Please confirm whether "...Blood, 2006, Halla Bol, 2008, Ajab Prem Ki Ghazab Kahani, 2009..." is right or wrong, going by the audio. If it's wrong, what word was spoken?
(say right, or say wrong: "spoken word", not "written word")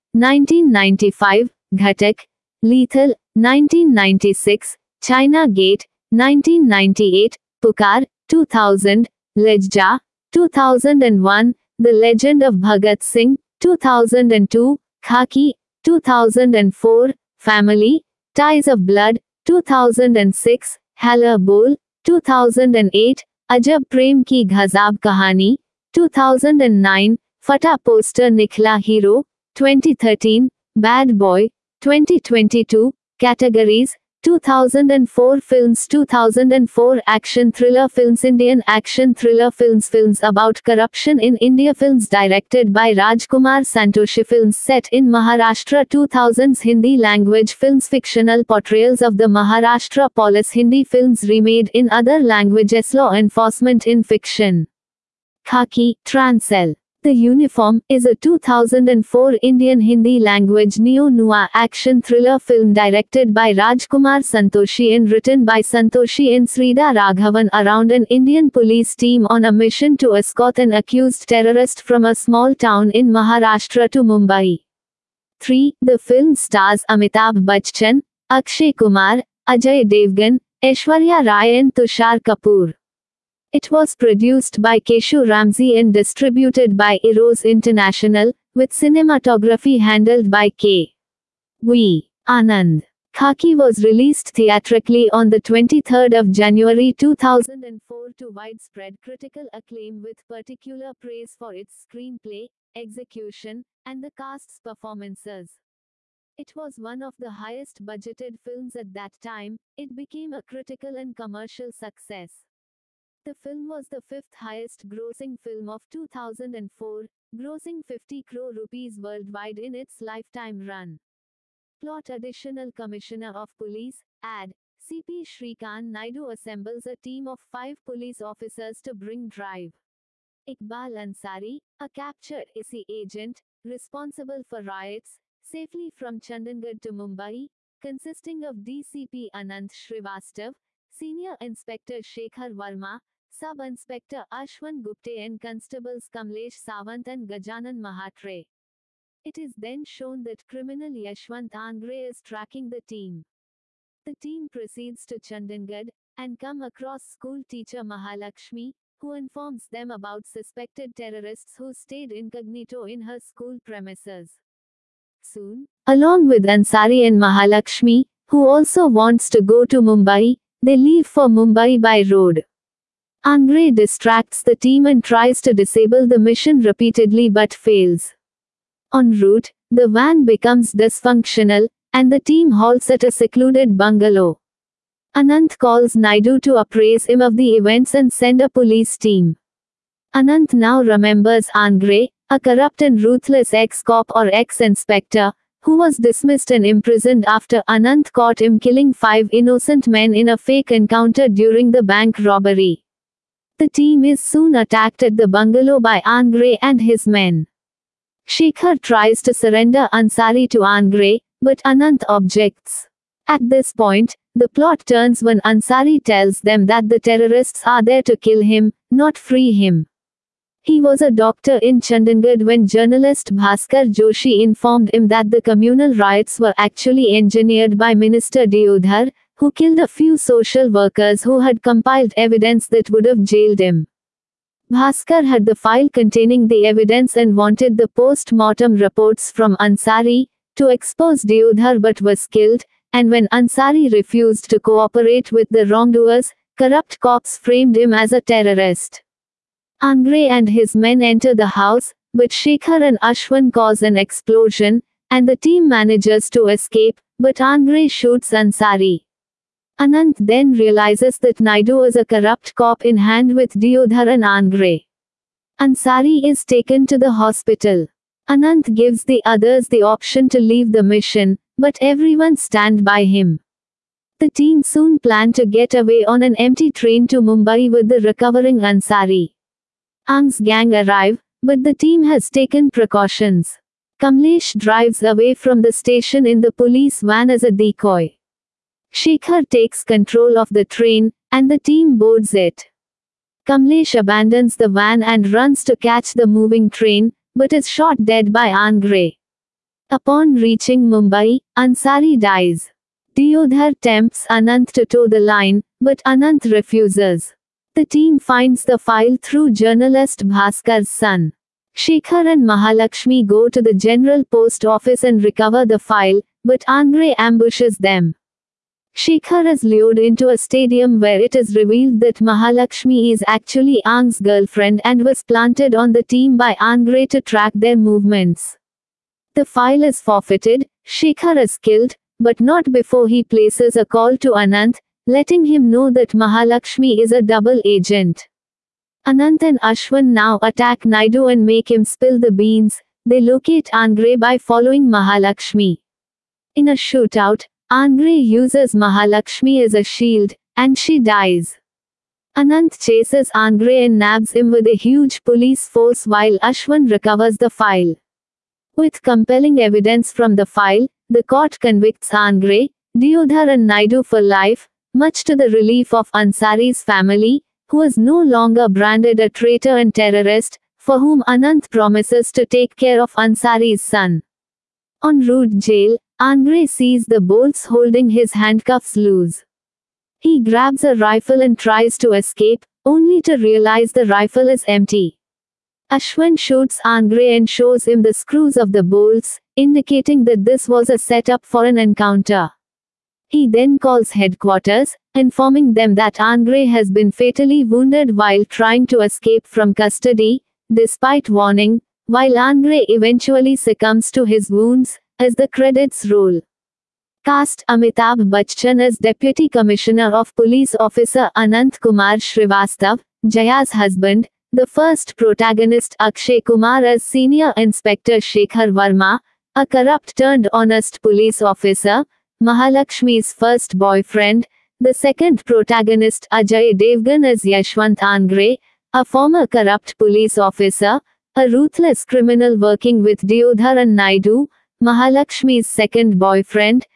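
right.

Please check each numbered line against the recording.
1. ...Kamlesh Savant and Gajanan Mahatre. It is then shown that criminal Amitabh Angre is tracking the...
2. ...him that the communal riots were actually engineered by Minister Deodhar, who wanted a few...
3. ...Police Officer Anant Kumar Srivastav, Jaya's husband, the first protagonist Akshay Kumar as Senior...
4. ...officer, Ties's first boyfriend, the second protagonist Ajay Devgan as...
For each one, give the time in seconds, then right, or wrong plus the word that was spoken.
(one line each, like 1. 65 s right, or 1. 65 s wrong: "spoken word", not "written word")
1. 146 s wrong: "Yashwant", not "Amitabh"
2. 224 s wrong: "killed", not "wanted"
3. 410 s right
4. 421 s wrong: "Mahalakshmi", not "Ties".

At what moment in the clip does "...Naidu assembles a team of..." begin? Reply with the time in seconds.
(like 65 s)
125 s.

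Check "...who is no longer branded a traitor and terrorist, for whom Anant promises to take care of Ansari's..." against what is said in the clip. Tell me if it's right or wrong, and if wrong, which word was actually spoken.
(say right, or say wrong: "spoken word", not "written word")
right.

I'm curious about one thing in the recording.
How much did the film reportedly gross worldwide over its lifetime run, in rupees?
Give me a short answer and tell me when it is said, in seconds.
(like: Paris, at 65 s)
50 crore, at 117 s.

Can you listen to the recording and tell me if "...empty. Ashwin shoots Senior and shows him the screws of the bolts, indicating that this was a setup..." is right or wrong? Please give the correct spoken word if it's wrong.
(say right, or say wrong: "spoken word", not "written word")
wrong: "Angre", not "Senior".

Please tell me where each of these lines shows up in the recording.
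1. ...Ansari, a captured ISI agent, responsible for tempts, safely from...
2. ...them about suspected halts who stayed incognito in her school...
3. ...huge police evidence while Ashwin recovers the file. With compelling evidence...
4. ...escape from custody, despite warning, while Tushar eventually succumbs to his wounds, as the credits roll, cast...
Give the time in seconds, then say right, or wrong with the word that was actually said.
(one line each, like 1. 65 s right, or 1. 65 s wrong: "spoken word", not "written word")
1. 131 s wrong: "riots", not "tempts"
2. 159 s wrong: "terrorists", not "halts"
3. 354 s wrong: "force", not "evidence"
4. 398 s wrong: "Angre", not "Tushar".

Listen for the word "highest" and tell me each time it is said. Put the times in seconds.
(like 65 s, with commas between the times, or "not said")
107 s, 114 s.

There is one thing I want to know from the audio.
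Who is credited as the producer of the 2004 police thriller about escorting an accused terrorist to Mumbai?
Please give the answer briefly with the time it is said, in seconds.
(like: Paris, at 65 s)
Keshu Ramsay, at 84 s.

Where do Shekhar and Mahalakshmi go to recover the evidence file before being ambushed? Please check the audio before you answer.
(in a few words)
General post office.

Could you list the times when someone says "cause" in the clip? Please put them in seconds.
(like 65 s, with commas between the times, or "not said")
253 s.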